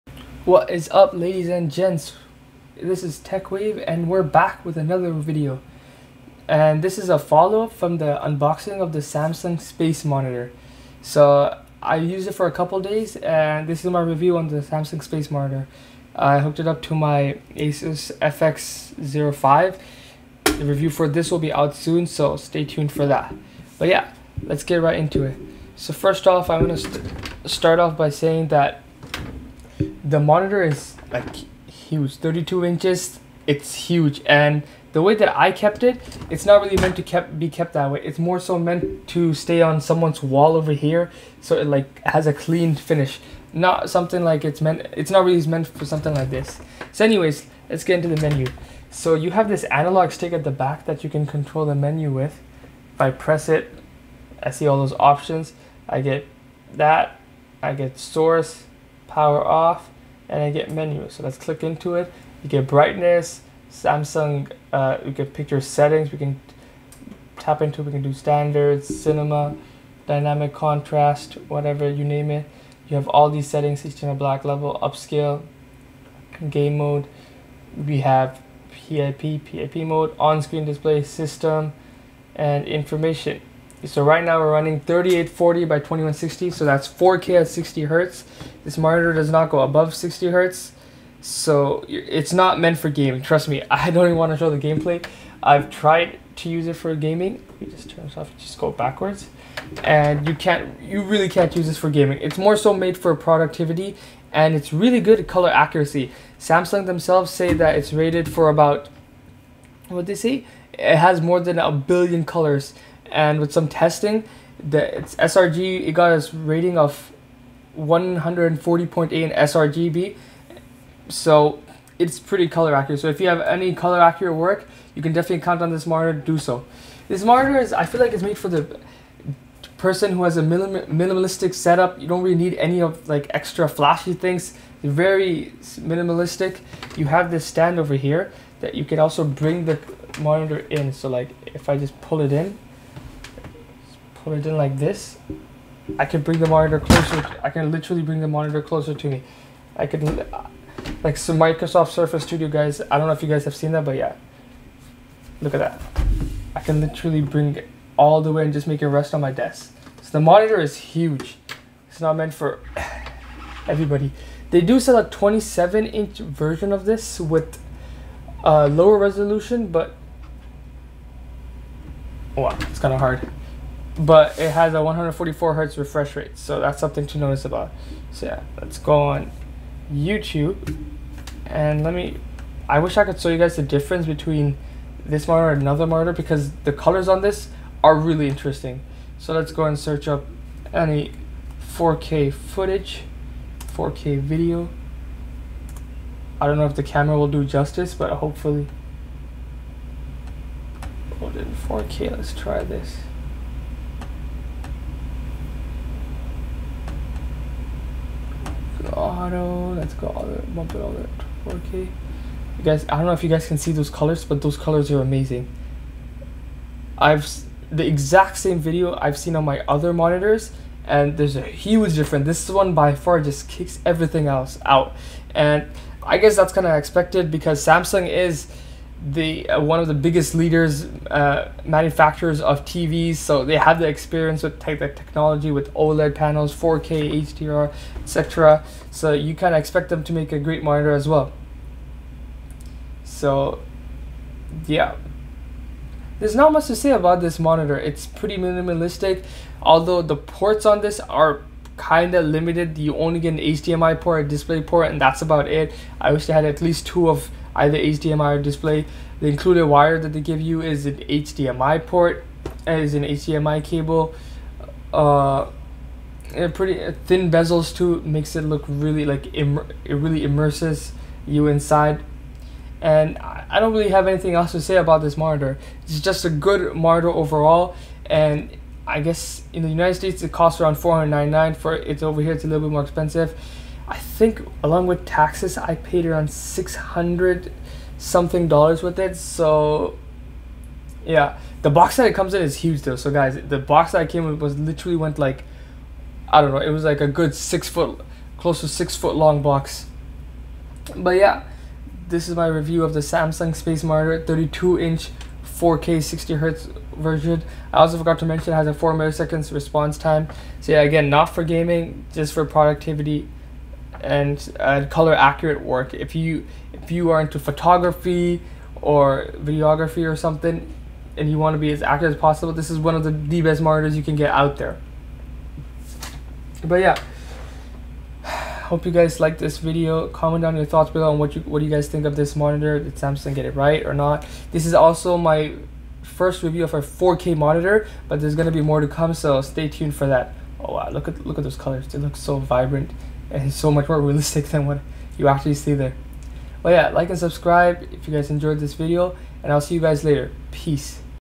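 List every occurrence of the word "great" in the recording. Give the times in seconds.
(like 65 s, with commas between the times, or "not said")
240 s.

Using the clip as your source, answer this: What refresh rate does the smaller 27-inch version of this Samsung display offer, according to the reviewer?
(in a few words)
144 hertz.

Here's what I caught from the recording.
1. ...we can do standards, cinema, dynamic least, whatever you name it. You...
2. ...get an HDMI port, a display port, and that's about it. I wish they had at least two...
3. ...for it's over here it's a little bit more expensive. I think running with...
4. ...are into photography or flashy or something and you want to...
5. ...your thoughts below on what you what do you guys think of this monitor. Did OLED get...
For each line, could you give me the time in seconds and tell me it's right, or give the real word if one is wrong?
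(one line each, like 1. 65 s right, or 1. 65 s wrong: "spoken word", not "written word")
1. 67 s wrong: "contrast", not "least"
2. 253 s right
3. 281 s wrong: "along", not "running"
4. 317 s wrong: "videography", not "flashy"
5. 330 s wrong: "Samsung", not "OLED".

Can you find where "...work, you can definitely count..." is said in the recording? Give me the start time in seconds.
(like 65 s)
124 s.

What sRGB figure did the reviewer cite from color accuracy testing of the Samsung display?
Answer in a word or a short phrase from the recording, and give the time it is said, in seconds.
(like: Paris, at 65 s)
140.8, at 117 s.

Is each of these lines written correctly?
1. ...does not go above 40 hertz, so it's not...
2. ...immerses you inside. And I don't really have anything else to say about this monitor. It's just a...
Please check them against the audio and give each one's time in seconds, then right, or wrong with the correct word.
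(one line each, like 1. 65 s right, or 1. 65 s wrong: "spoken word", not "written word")
1. 89 s wrong: "60", not "40"
2. 270 s right.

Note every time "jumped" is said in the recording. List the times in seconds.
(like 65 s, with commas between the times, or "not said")
not said.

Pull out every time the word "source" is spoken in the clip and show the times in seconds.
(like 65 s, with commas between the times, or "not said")
57 s.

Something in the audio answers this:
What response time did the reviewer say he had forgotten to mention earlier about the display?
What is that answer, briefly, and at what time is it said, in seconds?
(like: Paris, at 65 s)
4 milliseconds, at 308 s.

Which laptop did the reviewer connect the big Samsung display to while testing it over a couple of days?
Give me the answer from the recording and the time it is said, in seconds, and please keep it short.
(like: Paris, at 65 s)
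Asus FX05, at 17 s.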